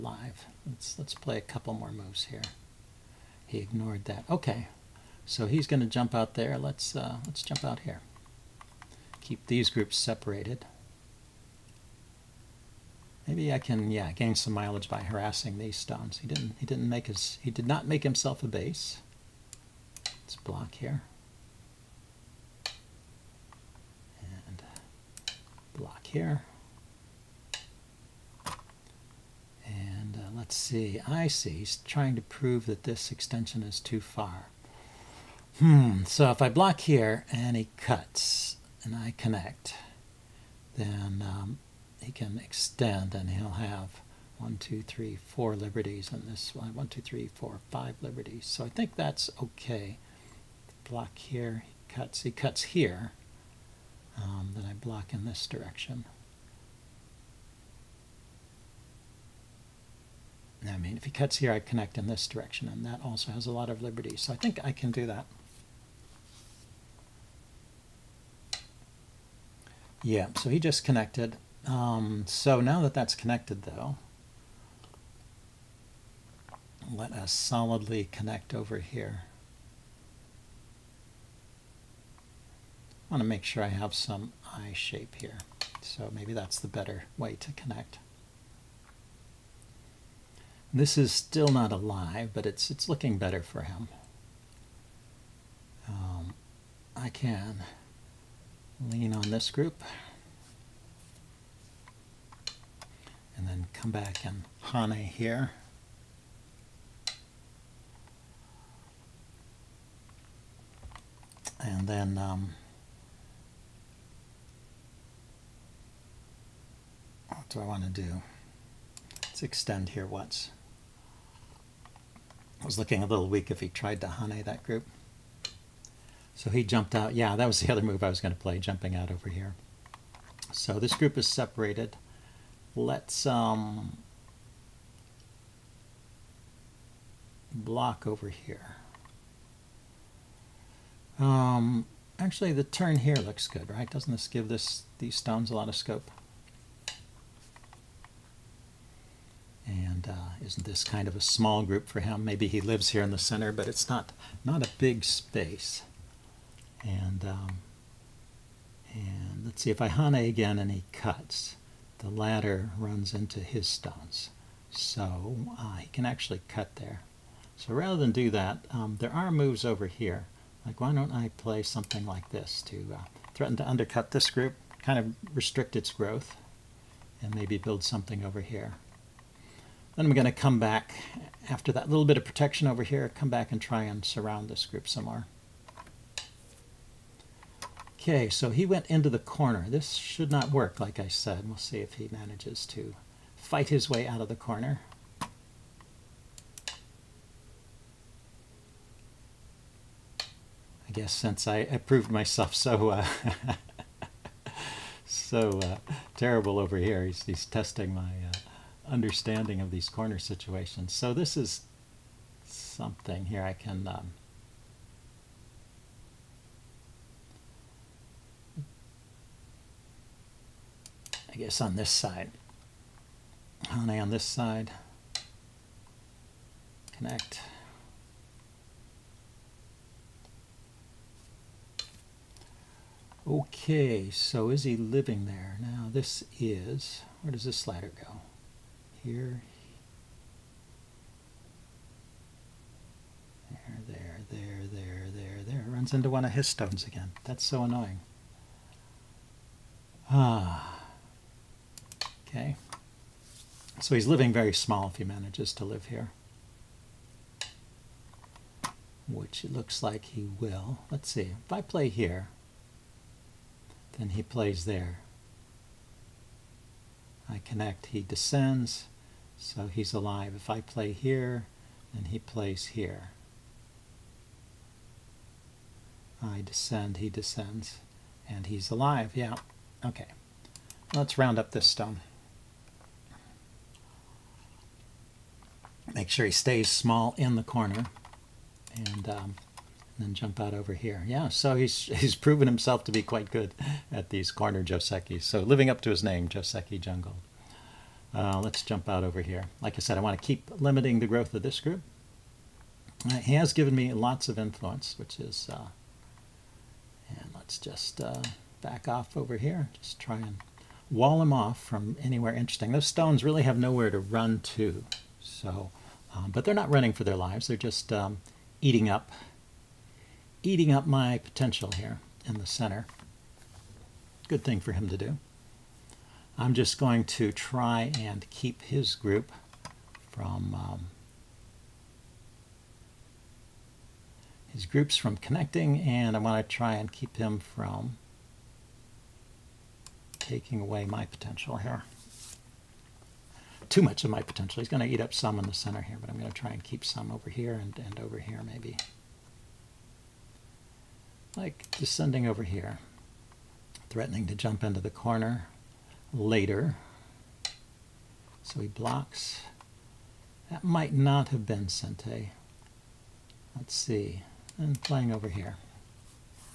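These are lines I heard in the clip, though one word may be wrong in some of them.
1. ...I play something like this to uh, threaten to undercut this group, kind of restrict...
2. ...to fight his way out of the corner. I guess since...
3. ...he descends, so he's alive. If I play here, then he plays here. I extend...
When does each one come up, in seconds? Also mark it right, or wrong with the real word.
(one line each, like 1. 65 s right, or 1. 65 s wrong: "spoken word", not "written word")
1. 171 s right
2. 192 s right
3. 267 s wrong: "descend", not "extend".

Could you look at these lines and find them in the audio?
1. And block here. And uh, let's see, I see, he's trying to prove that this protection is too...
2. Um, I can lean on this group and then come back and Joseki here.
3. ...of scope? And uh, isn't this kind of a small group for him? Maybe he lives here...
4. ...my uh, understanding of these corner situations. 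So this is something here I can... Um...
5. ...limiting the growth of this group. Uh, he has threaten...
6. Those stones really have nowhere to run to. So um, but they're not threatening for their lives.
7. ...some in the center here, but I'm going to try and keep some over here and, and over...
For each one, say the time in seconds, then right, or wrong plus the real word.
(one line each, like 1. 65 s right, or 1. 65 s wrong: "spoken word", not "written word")
1. 24 s wrong: "extension", not "protection"
2. 95 s wrong: "Hane", not "Joseki"
3. 145 s right
4. 207 s right
5. 300 s wrong: "given", not "threaten"
6. 312 s wrong: "running", not "threatening"
7. 345 s right.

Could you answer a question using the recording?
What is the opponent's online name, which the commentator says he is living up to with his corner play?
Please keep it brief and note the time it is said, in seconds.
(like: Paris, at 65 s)
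Joseki Jungle, at 296 s.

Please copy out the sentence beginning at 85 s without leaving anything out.
So maybe that's the better way to connect.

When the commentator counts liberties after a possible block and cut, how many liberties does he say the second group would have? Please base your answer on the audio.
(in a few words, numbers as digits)
5.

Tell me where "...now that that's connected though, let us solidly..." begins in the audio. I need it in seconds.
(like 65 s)
72 s.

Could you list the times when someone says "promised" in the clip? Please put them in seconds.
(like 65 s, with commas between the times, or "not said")
not said.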